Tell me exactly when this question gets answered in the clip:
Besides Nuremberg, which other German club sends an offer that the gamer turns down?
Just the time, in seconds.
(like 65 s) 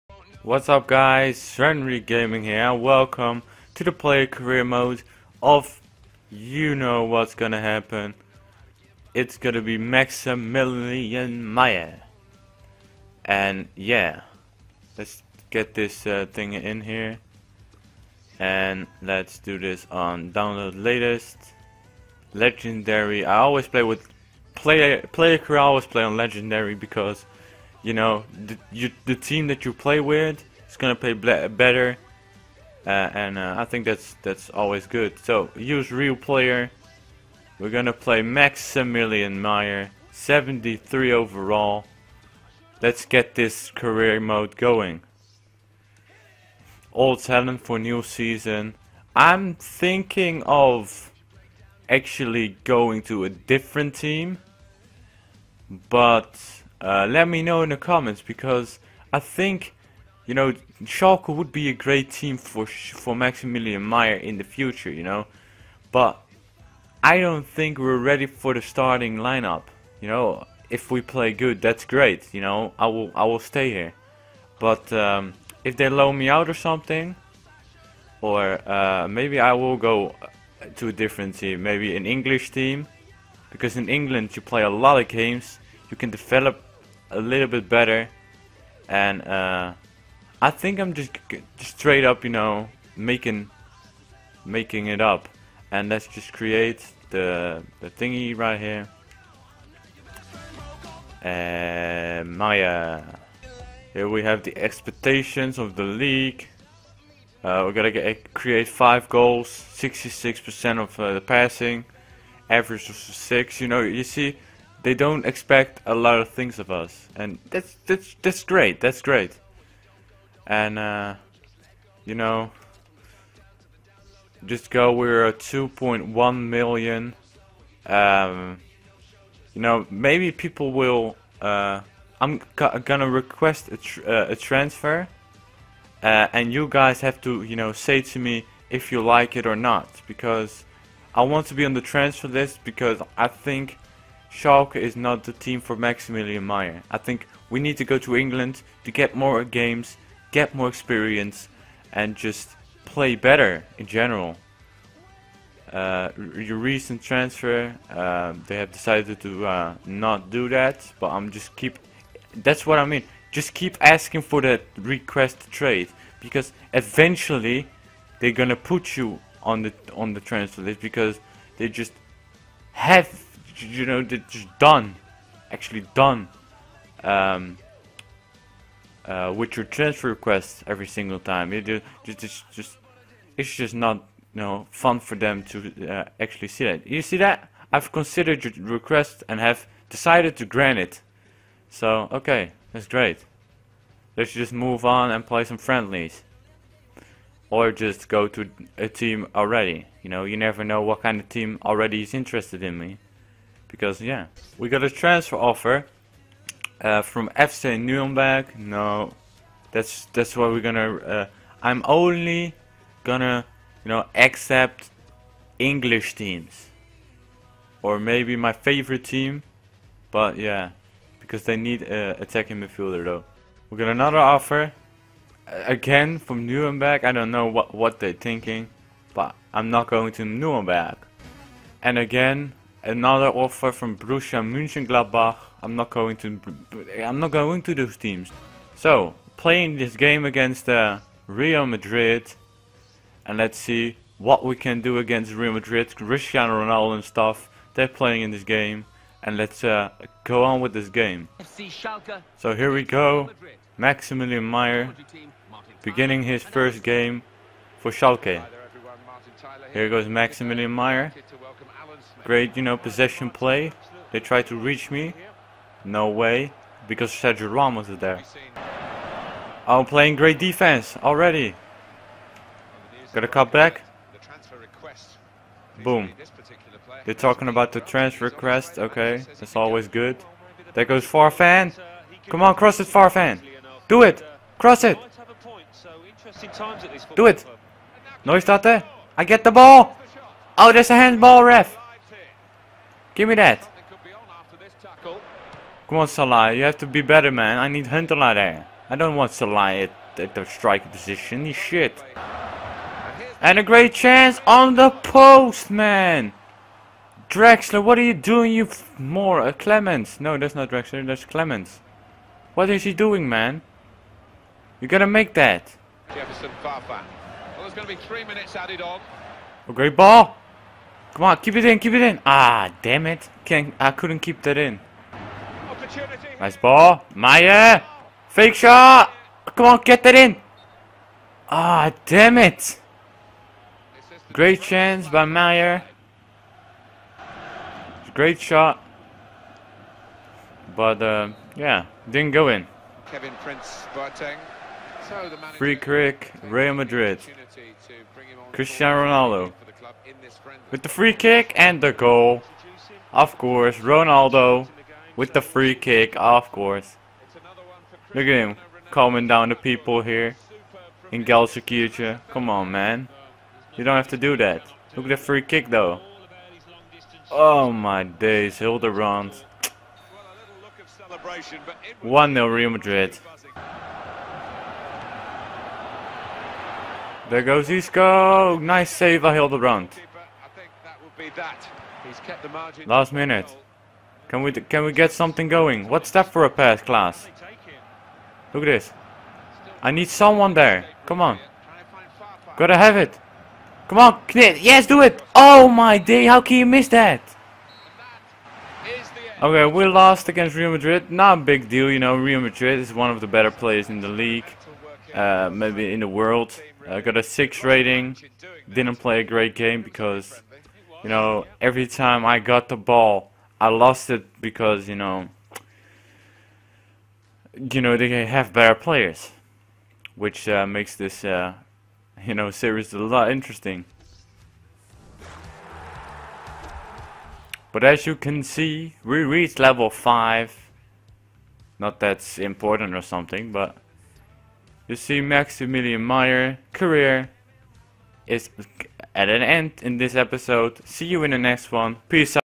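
233 s.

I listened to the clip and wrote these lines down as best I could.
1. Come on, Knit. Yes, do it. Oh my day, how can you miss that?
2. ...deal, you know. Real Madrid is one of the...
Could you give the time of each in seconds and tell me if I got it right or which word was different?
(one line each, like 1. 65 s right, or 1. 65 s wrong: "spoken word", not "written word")
1. 393 s right
2. 401 s right.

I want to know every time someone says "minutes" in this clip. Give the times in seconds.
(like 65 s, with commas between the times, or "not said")
318 s, 383 s.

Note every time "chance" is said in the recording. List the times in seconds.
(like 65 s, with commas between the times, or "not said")
303 s, 334 s.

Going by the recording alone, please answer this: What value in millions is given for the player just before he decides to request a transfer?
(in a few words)
2.1 million.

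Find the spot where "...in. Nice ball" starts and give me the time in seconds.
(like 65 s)
324 s.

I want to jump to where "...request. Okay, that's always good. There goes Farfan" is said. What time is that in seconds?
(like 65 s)
278 s.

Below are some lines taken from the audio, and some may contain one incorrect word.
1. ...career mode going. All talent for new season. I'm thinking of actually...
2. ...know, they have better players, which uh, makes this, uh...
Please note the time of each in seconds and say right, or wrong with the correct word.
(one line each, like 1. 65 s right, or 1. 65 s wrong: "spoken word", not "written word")
1. 43 s right
2. 417 s right.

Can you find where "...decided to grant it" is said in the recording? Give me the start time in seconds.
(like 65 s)
189 s.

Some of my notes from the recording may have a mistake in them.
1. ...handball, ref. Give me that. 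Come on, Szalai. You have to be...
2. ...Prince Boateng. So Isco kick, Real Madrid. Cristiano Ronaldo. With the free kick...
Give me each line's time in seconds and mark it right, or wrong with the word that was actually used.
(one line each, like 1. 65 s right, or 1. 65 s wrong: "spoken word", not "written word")
1. 290 s right
2. 343 s wrong: "Free", not "Isco".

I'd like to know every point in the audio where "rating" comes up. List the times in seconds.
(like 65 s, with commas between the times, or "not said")
407 s.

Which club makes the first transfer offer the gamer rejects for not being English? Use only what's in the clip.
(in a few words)
FC Nuremberg.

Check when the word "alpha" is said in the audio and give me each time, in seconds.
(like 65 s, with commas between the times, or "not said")
not said.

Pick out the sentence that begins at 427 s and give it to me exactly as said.
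But as you can see, we reached level 5.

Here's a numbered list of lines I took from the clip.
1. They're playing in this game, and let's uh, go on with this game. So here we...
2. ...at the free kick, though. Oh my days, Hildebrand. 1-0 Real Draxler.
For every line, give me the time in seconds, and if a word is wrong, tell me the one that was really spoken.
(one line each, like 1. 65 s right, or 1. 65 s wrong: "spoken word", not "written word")
1. 247 s right
2. 365 s wrong: "Madrid", not "Draxler".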